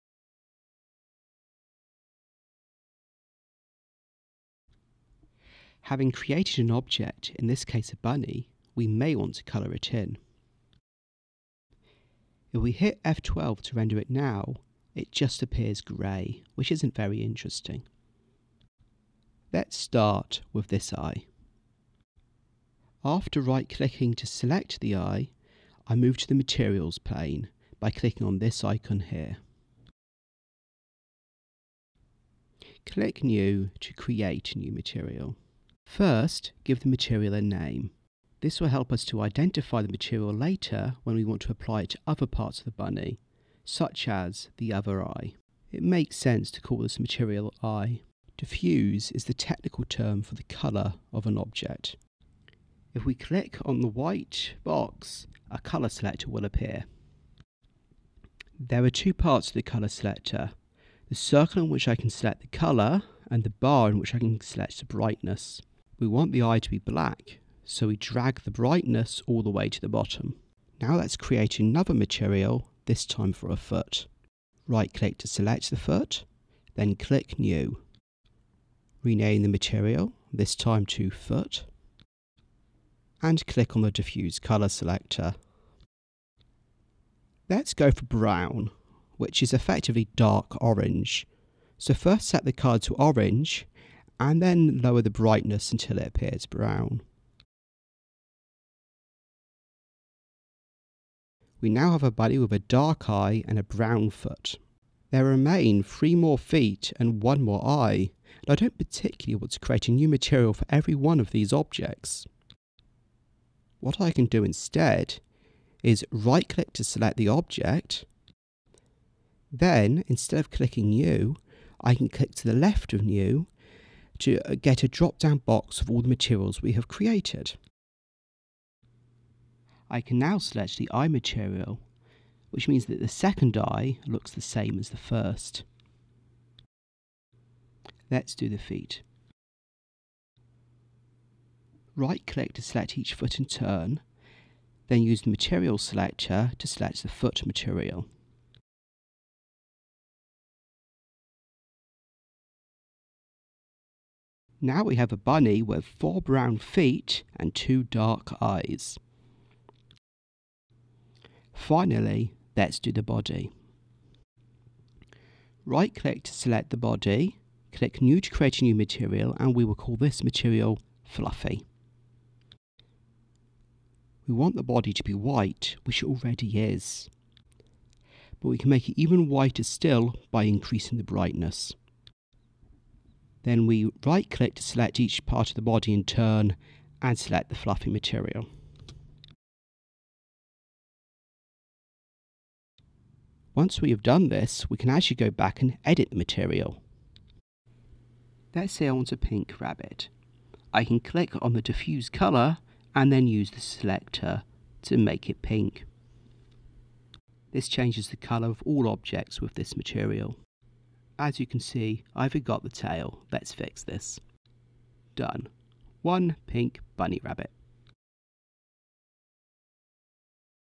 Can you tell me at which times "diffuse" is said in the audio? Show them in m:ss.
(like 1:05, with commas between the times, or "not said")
0:48, 1:23, 3:21.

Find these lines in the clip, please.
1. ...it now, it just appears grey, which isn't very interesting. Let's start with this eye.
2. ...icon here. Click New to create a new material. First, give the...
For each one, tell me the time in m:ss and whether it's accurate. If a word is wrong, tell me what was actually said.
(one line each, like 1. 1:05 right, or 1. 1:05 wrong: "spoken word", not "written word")
1. 0:13 right
2. 0:28 right.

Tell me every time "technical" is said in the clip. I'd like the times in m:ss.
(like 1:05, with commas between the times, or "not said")
0:49.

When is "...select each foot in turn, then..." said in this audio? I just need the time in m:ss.
2:22.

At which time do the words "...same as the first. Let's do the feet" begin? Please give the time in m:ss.
2:14.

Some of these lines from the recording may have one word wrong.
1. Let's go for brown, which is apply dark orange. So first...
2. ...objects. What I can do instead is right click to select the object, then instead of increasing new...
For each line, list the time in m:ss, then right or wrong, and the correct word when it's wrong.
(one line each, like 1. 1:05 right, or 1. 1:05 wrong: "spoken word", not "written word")
1. 1:27 wrong: "effectively", not "apply"
2. 1:51 wrong: "clicking", not "increasing".